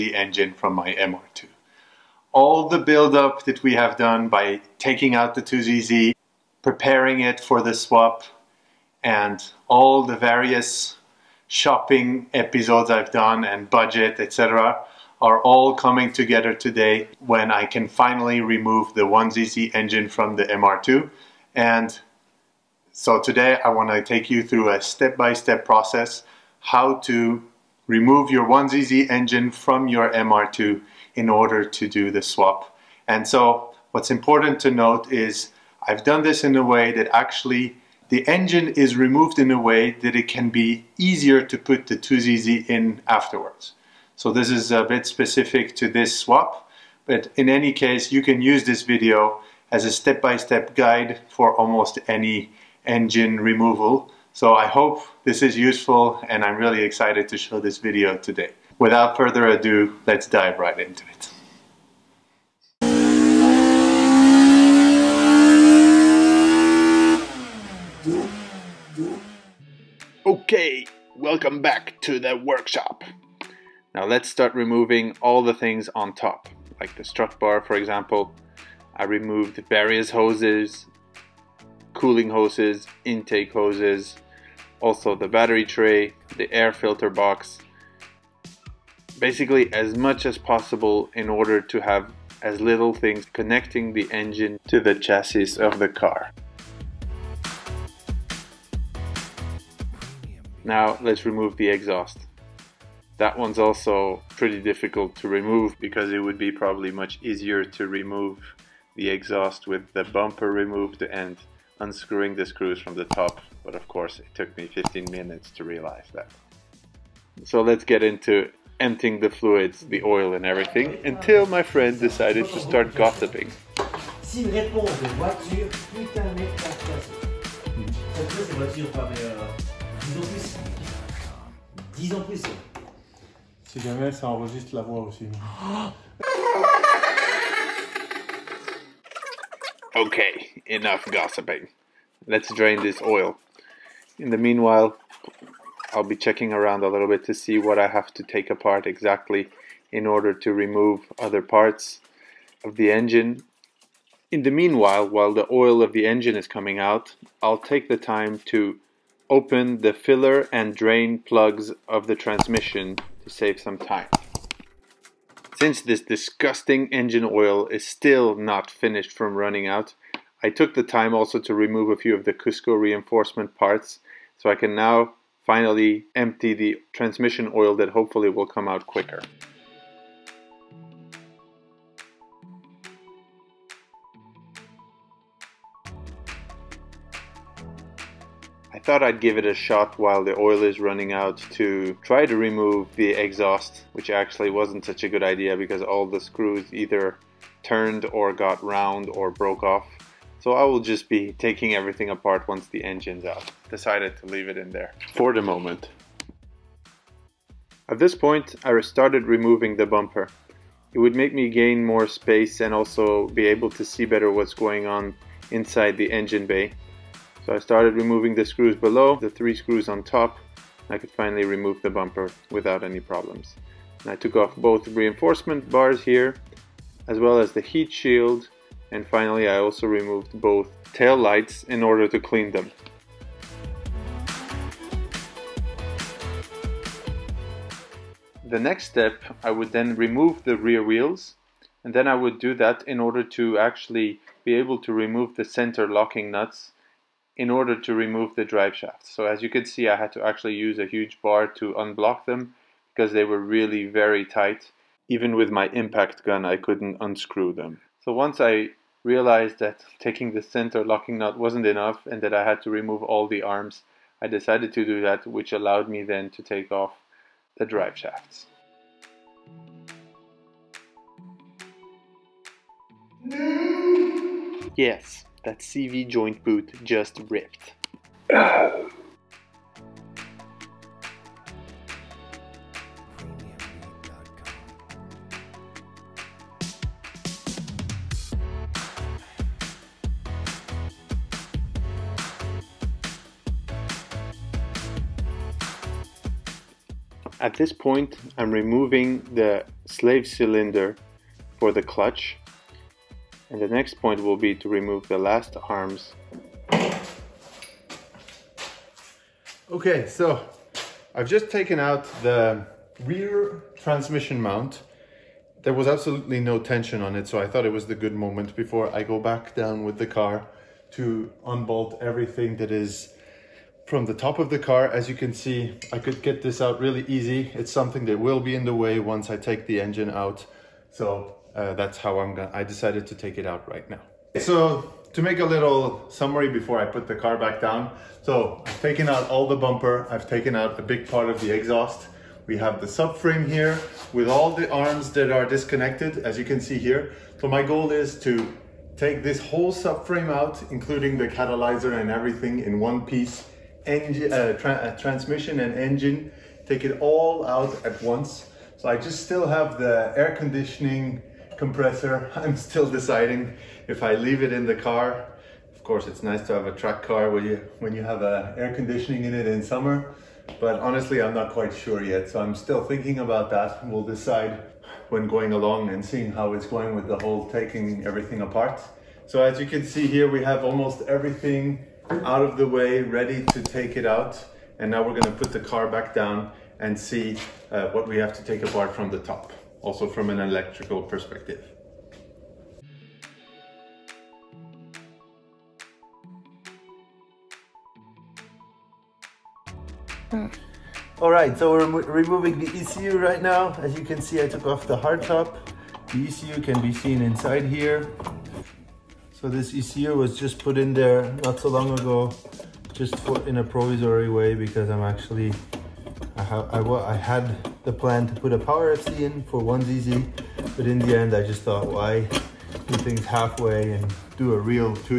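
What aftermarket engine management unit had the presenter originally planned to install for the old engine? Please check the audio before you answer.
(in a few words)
Power FC.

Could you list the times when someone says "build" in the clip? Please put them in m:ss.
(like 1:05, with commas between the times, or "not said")
0:02.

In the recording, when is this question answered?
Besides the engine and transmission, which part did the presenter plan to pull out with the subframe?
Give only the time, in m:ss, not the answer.
5:51.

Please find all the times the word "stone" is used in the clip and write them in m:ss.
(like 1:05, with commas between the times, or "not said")
not said.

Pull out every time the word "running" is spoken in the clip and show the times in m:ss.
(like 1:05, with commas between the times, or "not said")
2:49, 3:10.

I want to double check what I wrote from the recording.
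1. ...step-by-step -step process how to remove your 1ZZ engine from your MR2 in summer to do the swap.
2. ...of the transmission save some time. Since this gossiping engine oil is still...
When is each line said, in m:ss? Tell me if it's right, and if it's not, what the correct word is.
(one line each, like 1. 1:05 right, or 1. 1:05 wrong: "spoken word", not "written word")
1. 0:24 wrong: "order", not "summer"
2. 2:41 wrong: "disgusting", not "gossiping".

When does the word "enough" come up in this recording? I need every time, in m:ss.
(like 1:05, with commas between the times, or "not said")
2:20, 4:21.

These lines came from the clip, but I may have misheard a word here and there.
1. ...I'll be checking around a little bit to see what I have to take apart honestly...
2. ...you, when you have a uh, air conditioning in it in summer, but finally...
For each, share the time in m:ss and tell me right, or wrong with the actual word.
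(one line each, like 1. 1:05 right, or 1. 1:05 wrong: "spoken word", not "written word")
1. 2:25 wrong: "exactly", not "honestly"
2. 6:07 wrong: "honestly", not "finally".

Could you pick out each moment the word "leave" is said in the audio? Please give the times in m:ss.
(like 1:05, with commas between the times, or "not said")
3:24, 6:04.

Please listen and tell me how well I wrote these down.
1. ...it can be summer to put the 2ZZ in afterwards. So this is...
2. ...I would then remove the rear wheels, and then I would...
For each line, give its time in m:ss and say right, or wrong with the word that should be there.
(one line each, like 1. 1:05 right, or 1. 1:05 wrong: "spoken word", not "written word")
1. 0:40 wrong: "easier", not "summer"
2. 3:59 right.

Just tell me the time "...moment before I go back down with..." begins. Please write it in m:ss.
5:18.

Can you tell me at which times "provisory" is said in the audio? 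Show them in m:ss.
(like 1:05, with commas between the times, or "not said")
6:53.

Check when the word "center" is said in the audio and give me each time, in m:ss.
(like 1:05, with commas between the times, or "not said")
4:05, 4:20.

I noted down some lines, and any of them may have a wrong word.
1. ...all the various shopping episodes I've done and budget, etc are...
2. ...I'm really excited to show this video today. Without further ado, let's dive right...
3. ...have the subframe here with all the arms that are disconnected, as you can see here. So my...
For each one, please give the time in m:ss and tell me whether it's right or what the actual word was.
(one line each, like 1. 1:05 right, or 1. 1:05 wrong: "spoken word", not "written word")
1. 0:09 right
2. 0:56 right
3. 5:42 right.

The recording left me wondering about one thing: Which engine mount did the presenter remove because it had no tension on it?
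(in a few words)
Rear transmission mount.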